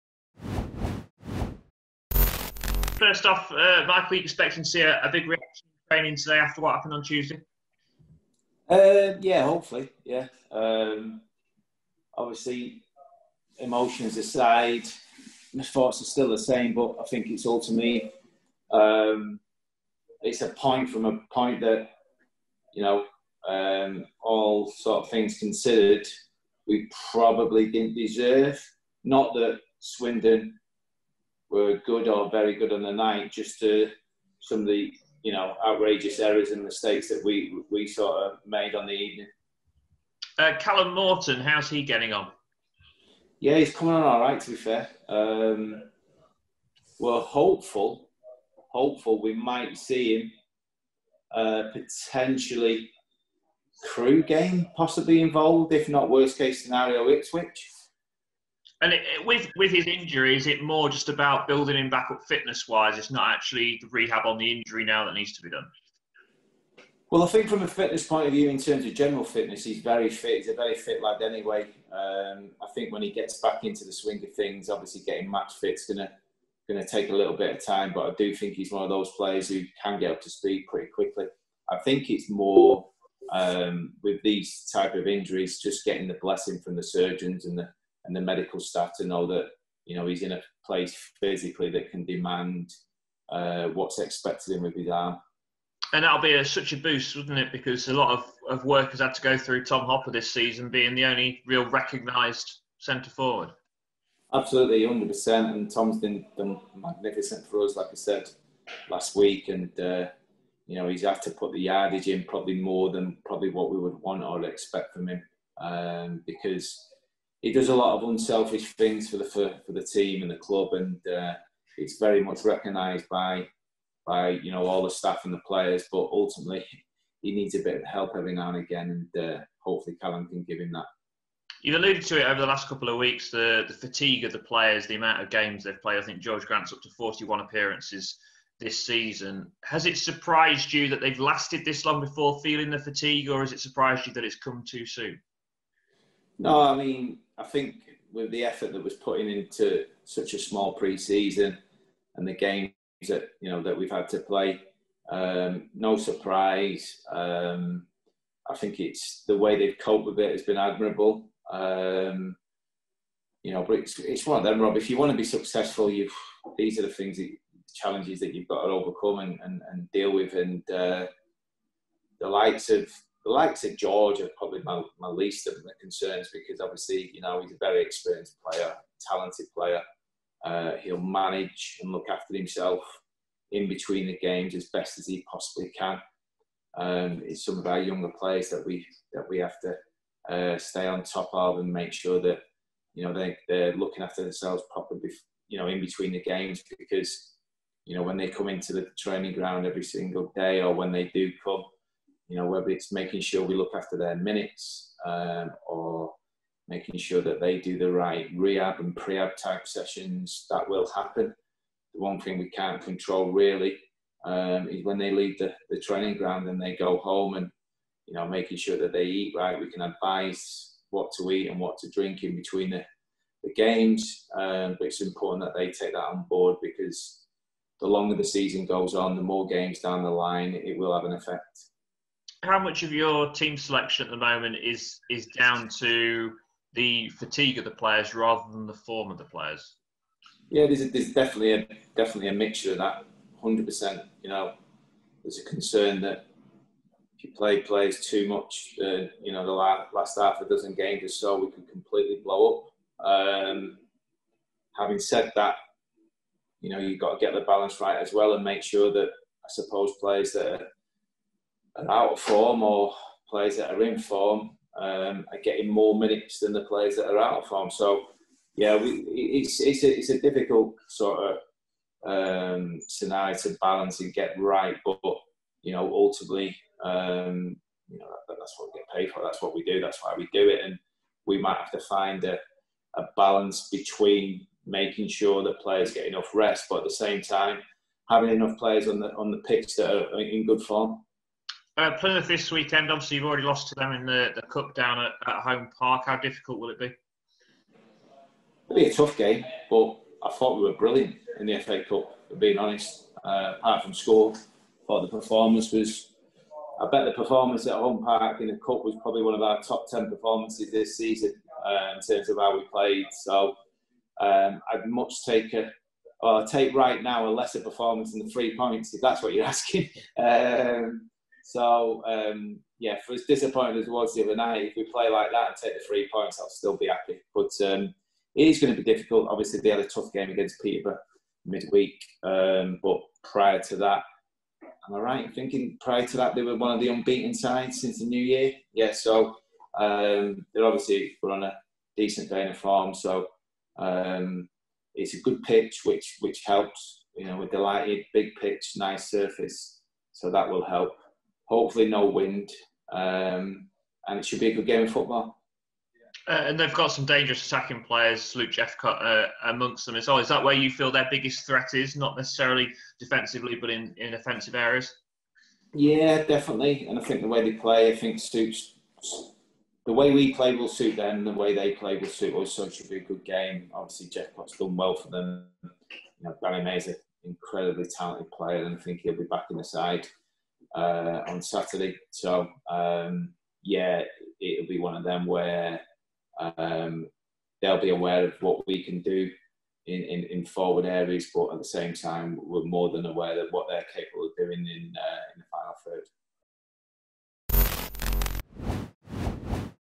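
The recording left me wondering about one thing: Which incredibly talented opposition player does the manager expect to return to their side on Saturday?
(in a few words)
Danny Mayor.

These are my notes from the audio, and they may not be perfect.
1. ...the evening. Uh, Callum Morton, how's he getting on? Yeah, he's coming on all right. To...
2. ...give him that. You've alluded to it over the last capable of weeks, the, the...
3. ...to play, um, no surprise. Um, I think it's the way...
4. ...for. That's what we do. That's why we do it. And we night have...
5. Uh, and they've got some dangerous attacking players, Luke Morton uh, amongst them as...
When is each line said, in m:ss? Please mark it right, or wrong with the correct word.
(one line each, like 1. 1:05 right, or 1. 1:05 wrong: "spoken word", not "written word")
1. 0:38 right
2. 2:10 wrong: "couple", not "capable"
3. 2:34 right
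4. 4:39 wrong: "might", not "night"
5. 5:56 wrong: "Jephcott", not "Morton".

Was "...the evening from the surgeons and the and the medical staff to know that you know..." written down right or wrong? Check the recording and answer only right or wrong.
wrong.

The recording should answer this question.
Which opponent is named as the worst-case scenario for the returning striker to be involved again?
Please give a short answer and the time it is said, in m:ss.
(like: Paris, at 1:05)
Ipswich, at 0:57.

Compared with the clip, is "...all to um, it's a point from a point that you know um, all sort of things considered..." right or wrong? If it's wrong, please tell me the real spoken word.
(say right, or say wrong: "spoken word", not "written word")
right.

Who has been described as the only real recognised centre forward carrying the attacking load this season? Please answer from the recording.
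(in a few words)
Tom Hopper.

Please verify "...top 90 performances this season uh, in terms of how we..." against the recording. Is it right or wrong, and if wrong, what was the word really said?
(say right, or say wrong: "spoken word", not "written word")
wrong: "10", not "90".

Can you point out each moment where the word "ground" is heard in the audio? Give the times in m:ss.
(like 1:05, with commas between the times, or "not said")
3:19, 3:36.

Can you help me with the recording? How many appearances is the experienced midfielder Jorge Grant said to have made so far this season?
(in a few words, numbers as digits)
41.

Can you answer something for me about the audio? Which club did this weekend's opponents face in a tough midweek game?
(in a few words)
Peterborough.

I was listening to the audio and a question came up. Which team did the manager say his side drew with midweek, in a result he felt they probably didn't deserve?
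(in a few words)
Swindon.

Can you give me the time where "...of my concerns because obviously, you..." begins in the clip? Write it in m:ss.
2:55.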